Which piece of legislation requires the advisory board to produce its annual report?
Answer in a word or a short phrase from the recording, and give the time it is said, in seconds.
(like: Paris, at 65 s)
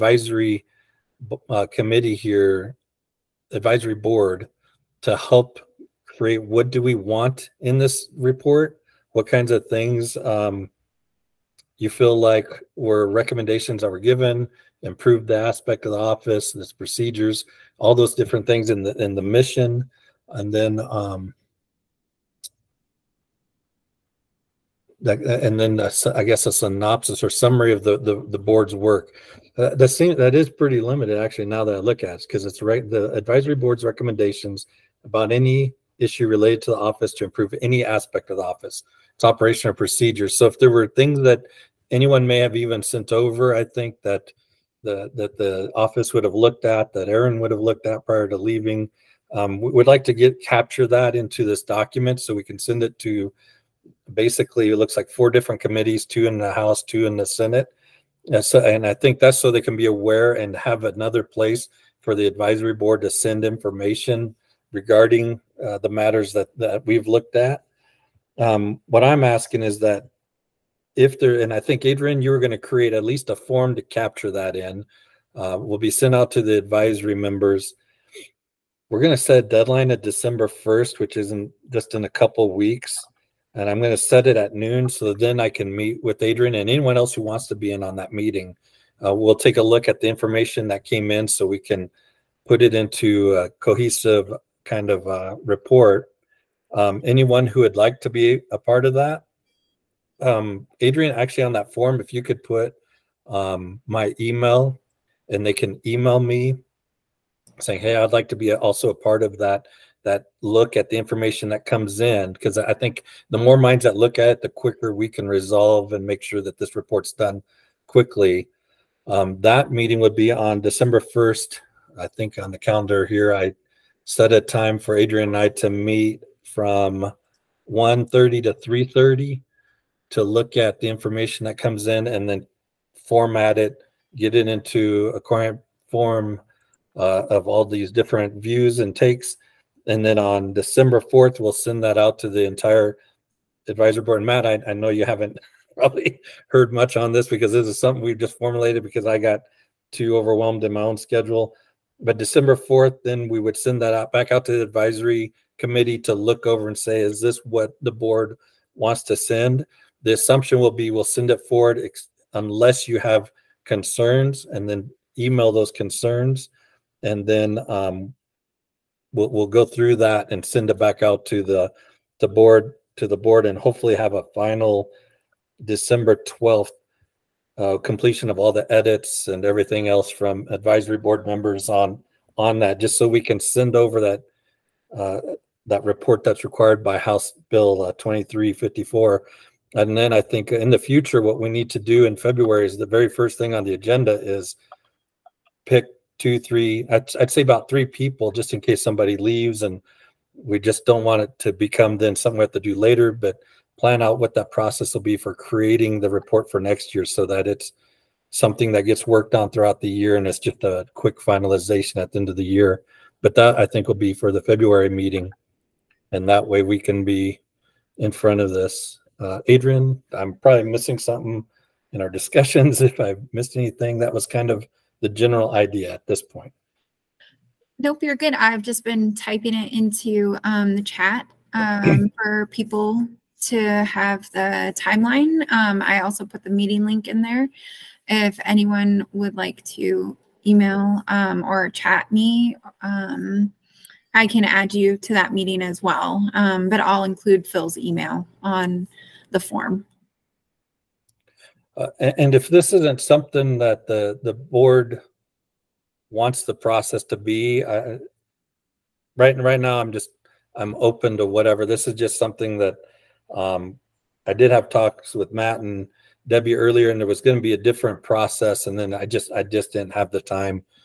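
House Bill 2354, at 186 s.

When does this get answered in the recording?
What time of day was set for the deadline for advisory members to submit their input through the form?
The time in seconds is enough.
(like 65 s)
84 s.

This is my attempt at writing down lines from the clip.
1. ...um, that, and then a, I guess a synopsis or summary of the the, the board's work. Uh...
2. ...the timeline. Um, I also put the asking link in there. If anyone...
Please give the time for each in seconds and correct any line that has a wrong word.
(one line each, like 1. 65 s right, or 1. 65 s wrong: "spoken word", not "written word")
1. 20 s right
2. 234 s wrong: "meeting", not "asking".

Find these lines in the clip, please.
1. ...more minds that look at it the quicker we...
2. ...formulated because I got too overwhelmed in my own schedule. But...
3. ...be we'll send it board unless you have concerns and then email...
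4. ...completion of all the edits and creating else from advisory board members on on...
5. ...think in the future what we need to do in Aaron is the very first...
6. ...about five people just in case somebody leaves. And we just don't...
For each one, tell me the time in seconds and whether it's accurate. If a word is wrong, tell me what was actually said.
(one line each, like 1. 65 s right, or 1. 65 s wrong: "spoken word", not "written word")
1. 113 s right
2. 148 s right
3. 160 s wrong: "forward", not "board"
4. 177 s wrong: "everything", not "creating"
5. 190 s wrong: "February", not "Aaron"
6. 197 s wrong: "three", not "five".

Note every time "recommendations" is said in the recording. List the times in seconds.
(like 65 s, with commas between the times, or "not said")
13 s, 33 s.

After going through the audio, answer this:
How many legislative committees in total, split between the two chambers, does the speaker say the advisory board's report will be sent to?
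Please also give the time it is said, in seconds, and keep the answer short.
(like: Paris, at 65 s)
4, at 55 s.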